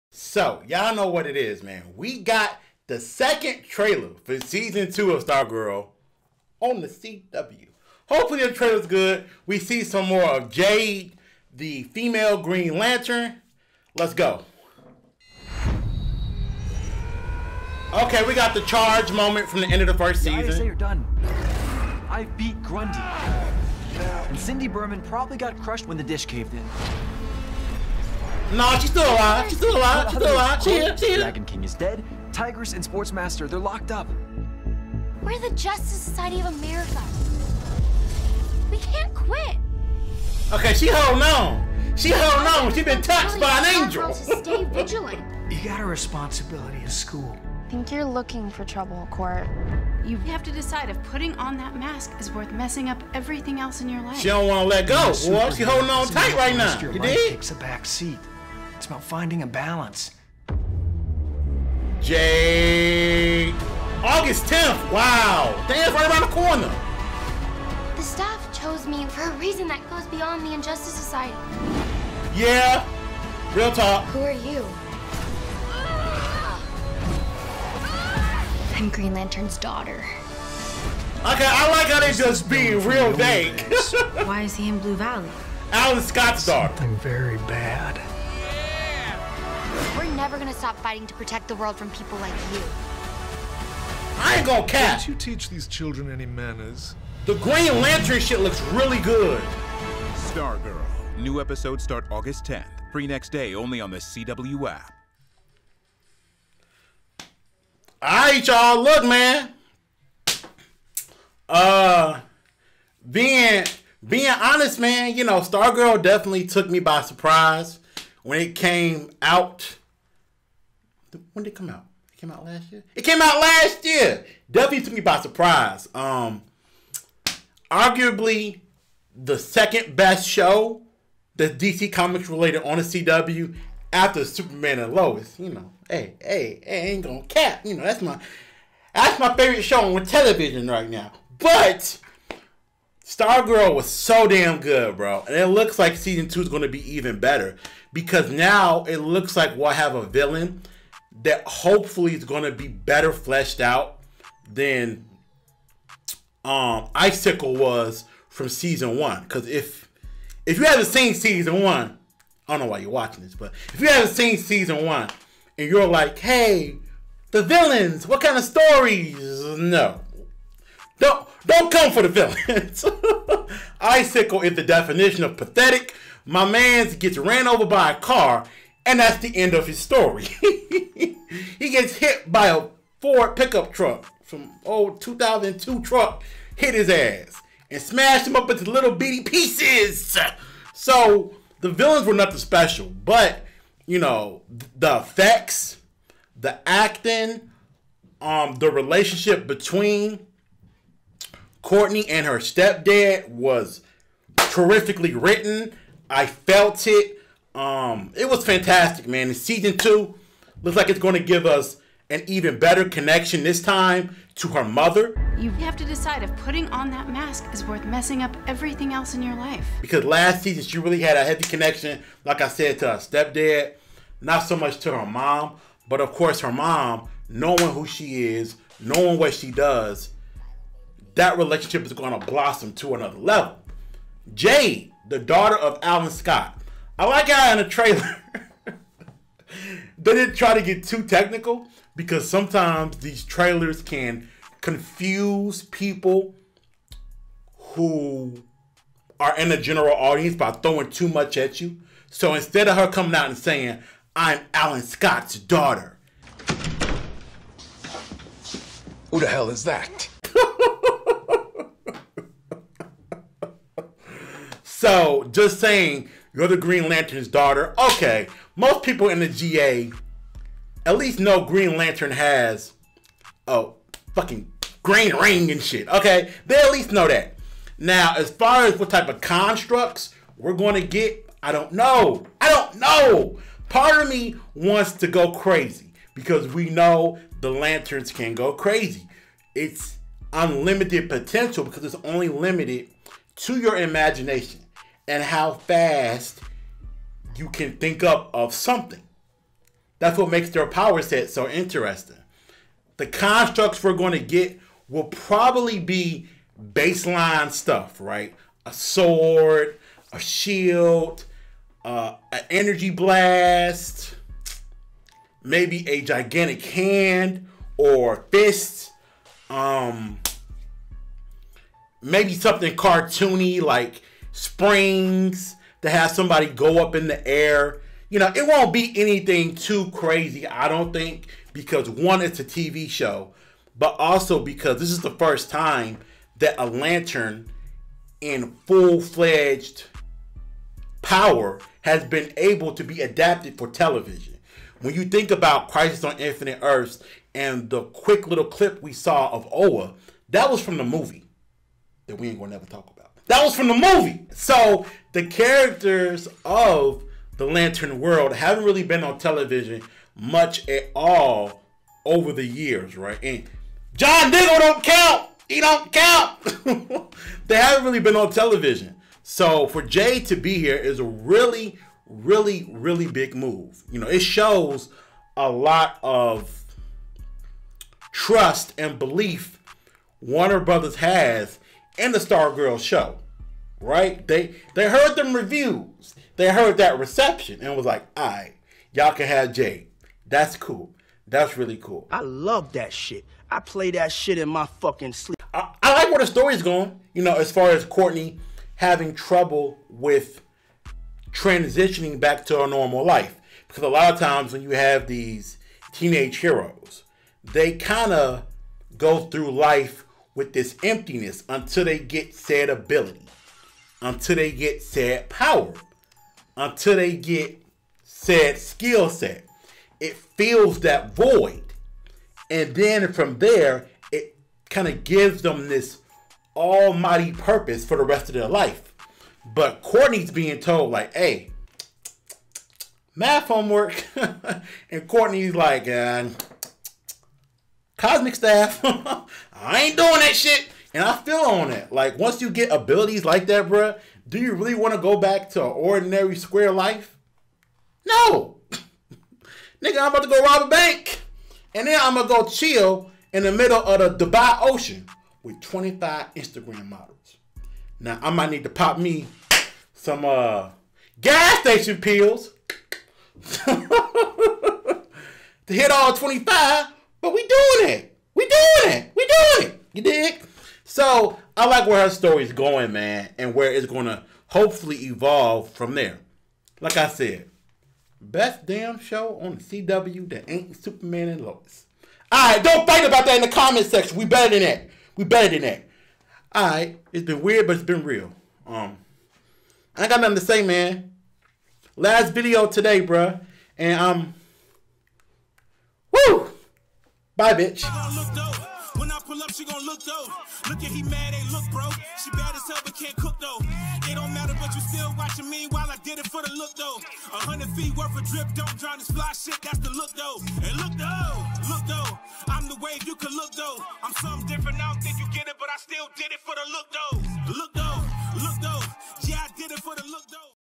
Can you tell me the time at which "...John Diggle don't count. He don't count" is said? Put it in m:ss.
6:03.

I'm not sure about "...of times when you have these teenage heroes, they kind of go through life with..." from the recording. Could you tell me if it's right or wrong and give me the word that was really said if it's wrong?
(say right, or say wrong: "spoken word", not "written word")
right.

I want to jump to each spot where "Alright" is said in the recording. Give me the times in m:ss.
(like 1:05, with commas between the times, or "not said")
1:48, 8:02, 8:06.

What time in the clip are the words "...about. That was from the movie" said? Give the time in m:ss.
5:52.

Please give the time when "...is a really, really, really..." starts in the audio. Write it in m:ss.
6:10.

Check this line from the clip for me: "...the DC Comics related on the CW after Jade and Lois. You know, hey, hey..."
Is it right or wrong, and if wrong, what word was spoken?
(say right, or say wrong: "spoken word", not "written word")
wrong: "Superman", not "Jade".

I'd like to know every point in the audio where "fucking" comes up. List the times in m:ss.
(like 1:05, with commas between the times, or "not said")
4:34, 6:34.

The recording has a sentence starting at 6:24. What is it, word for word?
They they heard them reviews, they heard that reception, and was like, "All right, y'all can have Jade.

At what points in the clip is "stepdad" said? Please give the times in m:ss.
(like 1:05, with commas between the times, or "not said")
3:22, 3:42.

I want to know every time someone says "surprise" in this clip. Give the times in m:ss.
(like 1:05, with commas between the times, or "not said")
1:57, 2:05.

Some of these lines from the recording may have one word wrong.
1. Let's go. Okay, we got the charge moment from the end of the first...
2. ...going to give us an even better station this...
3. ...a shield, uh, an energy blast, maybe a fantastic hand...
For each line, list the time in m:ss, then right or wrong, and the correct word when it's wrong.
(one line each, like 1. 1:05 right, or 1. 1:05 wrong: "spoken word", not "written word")
1. 0:13 right
2. 3:30 wrong: "connection", not "station"
3. 5:10 wrong: "gigantic", not "fantastic".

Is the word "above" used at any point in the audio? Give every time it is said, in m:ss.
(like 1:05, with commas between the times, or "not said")
not said.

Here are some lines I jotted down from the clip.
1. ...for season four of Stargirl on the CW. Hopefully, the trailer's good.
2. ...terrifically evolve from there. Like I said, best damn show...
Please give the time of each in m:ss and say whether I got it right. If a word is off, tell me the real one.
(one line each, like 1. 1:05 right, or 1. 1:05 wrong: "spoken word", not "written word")
1. 0:04 wrong: "two", not "four"
2. 7:54 wrong: "hopefully", not "terrifically".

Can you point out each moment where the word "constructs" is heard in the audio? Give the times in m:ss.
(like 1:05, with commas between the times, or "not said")
4:39, 5:03.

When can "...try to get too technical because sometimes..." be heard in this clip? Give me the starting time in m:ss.
4:00.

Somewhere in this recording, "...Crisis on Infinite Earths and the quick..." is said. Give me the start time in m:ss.
5:45.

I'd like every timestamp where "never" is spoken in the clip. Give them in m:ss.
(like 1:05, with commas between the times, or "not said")
1:30, 5:52.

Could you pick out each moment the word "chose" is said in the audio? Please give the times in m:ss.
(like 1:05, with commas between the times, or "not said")
1:08.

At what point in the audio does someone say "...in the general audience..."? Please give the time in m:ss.
4:09.